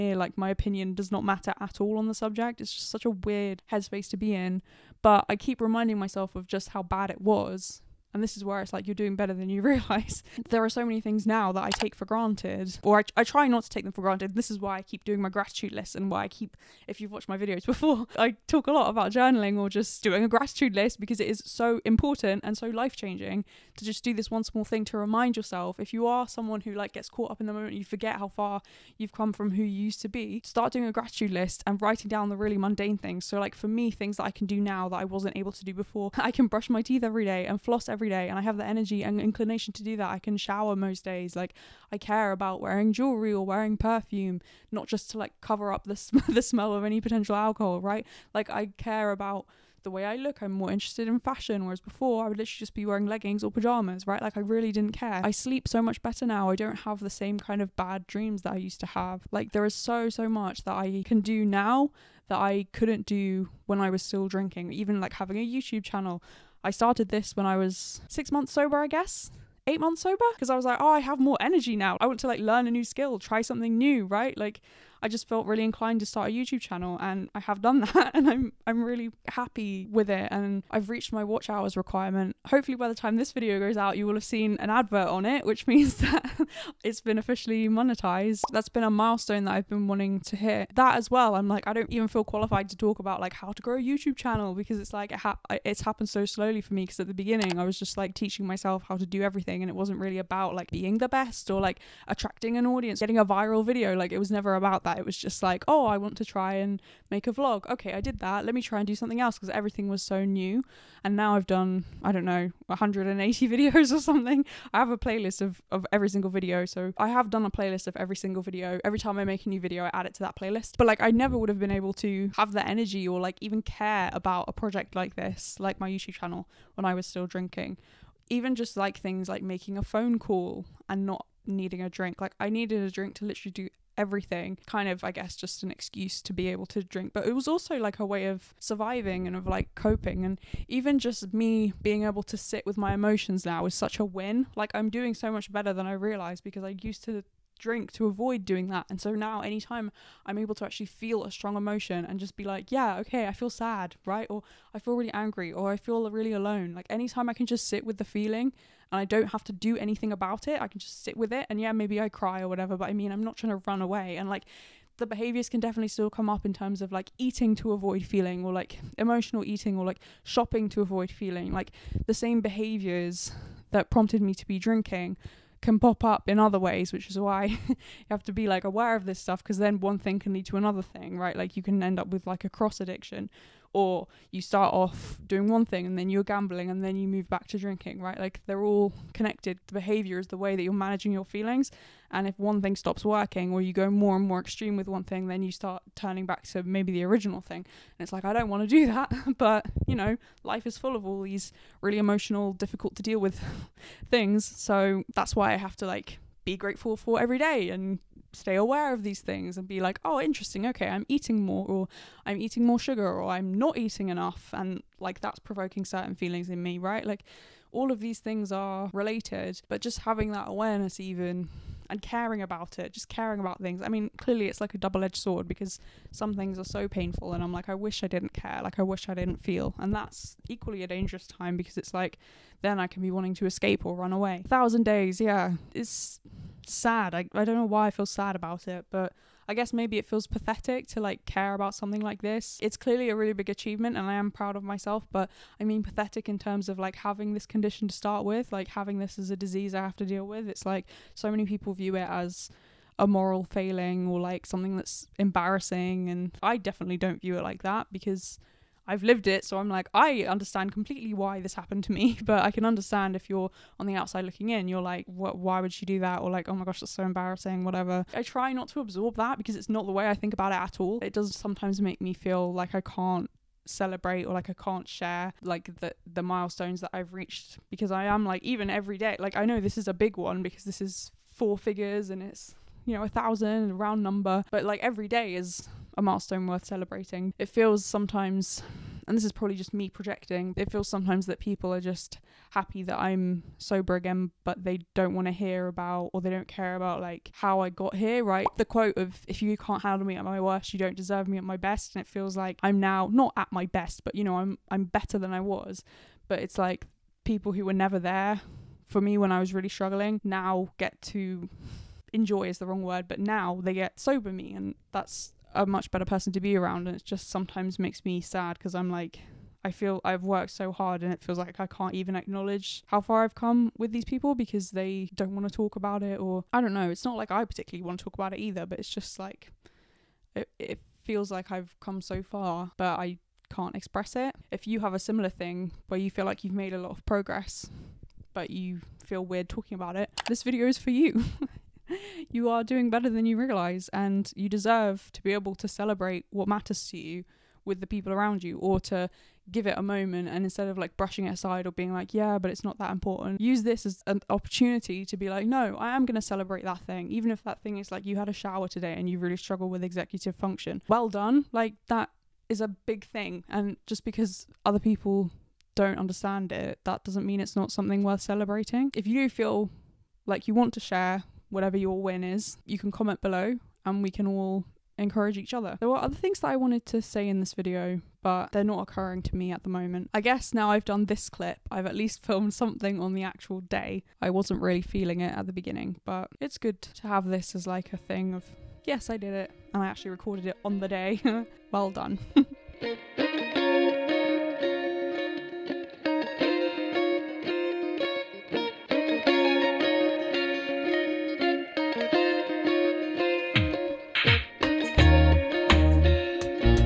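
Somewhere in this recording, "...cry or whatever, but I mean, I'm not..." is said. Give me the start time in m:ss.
2:42.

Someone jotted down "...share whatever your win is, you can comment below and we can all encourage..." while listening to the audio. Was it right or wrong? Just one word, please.
right.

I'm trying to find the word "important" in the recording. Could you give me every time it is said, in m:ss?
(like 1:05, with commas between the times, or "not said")
0:21, 5:52.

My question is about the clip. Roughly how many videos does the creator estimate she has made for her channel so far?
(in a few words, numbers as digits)
180.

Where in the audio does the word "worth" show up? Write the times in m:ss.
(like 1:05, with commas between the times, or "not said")
4:46, 6:08.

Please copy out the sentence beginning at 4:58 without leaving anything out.
The quote of, if you can't handle me at my worst, you don't deserve me at my best.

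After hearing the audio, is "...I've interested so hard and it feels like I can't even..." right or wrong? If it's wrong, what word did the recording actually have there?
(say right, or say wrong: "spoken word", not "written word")
wrong: "worked", not "interested".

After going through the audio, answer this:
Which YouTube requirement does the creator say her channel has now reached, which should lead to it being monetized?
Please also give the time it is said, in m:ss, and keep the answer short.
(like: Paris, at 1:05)
watch hours requirement, at 1:21.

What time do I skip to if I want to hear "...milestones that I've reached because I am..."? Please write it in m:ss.
4:36.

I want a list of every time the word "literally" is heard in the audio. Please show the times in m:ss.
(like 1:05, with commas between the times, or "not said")
0:52, 2:13.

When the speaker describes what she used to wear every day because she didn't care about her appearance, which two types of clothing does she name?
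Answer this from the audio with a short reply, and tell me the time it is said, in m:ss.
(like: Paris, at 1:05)
leggings or pajamas, at 0:53.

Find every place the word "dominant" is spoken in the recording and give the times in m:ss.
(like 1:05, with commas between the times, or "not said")
not said.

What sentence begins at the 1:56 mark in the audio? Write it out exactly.
So I have done a playlist of every single video.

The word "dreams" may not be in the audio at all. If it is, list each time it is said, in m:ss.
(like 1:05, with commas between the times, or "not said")
0:58.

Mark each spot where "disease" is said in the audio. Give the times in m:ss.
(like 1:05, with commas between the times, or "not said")
4:09.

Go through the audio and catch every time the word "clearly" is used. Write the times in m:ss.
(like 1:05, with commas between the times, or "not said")
3:44, 4:02.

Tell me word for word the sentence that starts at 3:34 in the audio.
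And like that's provoking certain feelings in me, right?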